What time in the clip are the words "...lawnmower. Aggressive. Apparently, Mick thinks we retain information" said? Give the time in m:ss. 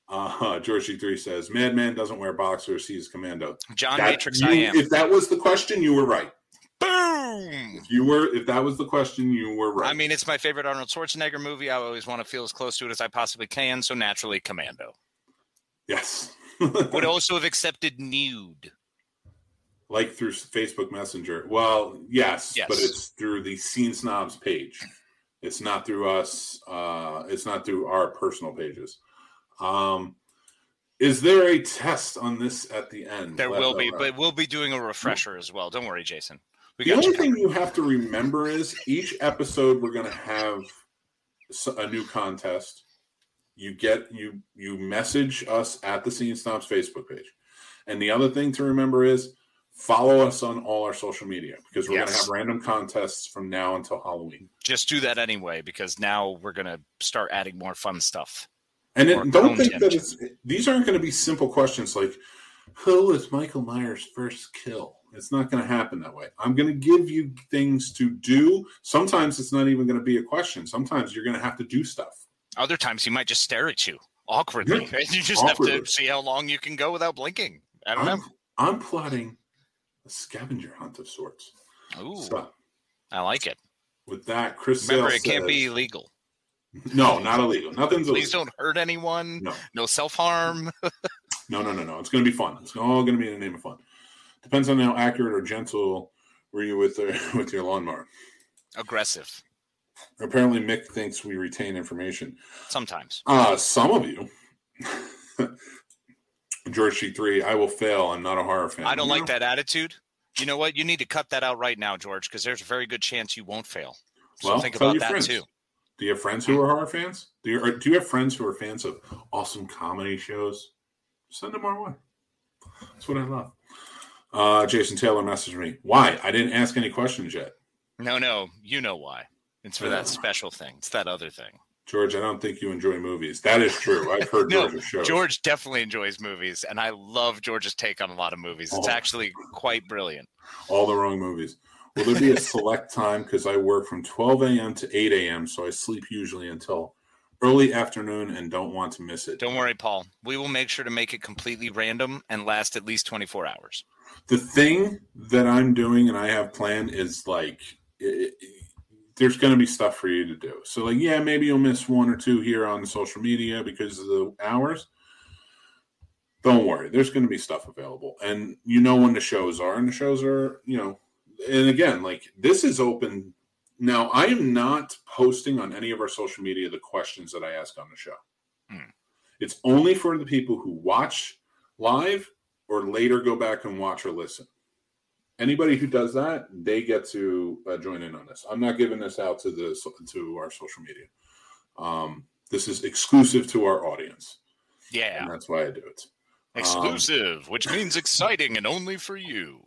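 1:37.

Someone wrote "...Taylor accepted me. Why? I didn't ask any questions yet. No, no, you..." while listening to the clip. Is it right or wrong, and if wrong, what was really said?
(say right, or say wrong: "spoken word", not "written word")
wrong: "messaged", not "accepted".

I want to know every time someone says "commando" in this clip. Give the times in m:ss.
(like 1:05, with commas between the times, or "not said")
0:03, 0:14.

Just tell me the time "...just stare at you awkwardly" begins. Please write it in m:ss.
1:13.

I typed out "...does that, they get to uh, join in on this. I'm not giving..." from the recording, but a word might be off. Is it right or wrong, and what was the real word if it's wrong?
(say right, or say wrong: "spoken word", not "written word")
right.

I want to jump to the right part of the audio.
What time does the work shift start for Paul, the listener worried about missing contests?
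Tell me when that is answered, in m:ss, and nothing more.
2:24.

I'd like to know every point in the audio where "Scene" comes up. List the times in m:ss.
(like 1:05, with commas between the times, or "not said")
0:23, 0:46.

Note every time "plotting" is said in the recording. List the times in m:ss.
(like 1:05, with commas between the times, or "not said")
1:18.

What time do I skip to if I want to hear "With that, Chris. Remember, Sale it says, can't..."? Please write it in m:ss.
1:24.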